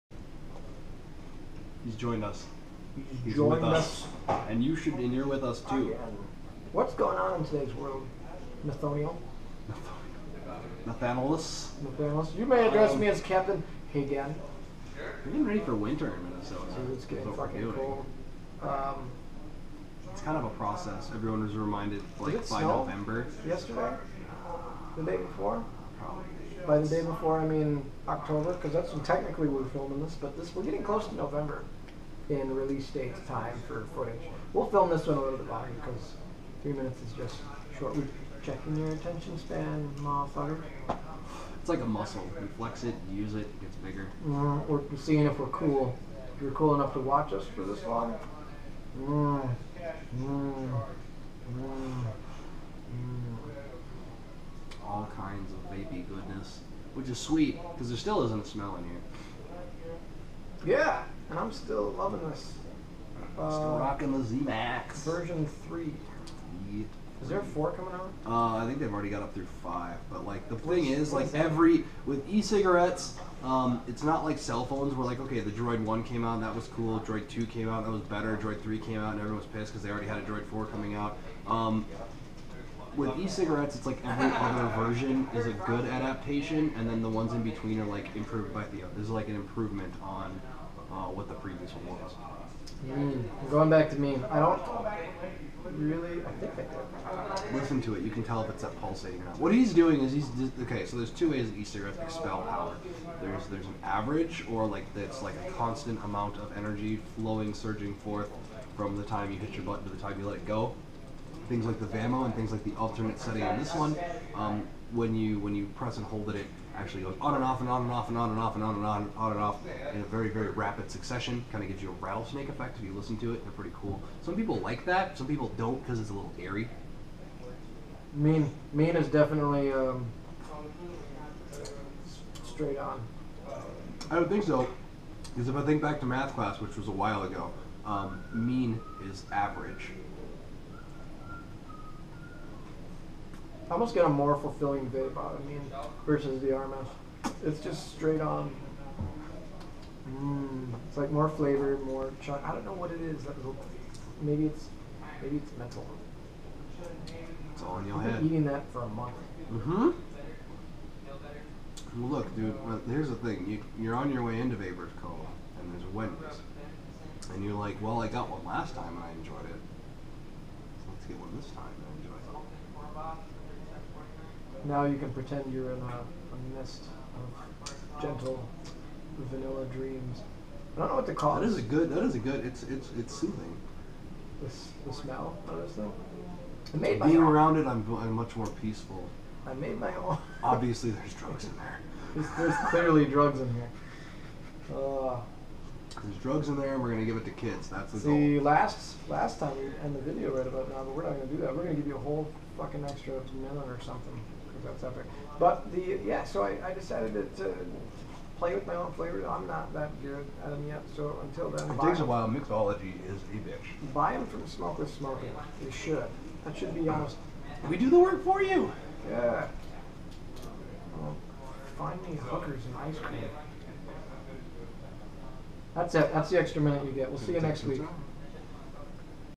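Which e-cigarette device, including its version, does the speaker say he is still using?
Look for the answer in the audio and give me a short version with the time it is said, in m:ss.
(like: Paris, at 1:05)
Z Max Version 3, at 1:04.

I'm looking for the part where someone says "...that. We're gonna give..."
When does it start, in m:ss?
3:21.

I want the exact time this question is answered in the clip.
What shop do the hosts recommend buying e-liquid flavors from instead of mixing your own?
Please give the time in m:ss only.
3:34.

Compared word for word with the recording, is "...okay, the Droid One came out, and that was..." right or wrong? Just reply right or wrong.
right.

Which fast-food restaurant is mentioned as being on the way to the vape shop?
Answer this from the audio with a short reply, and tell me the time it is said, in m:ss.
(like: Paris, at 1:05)
Wendy's, at 2:45.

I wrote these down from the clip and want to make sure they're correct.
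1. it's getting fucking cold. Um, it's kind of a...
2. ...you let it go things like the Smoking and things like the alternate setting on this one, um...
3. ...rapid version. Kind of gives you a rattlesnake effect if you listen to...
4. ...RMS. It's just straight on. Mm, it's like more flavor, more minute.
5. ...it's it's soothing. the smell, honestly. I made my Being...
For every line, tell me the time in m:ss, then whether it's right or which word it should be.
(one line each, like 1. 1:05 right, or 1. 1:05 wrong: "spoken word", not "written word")
1. 0:16 right
2. 1:50 wrong: "VAMO", not "Smoking"
3. 2:00 wrong: "succession", not "version"
4. 2:26 wrong: "chocolate", not "minute"
5. 3:02 right.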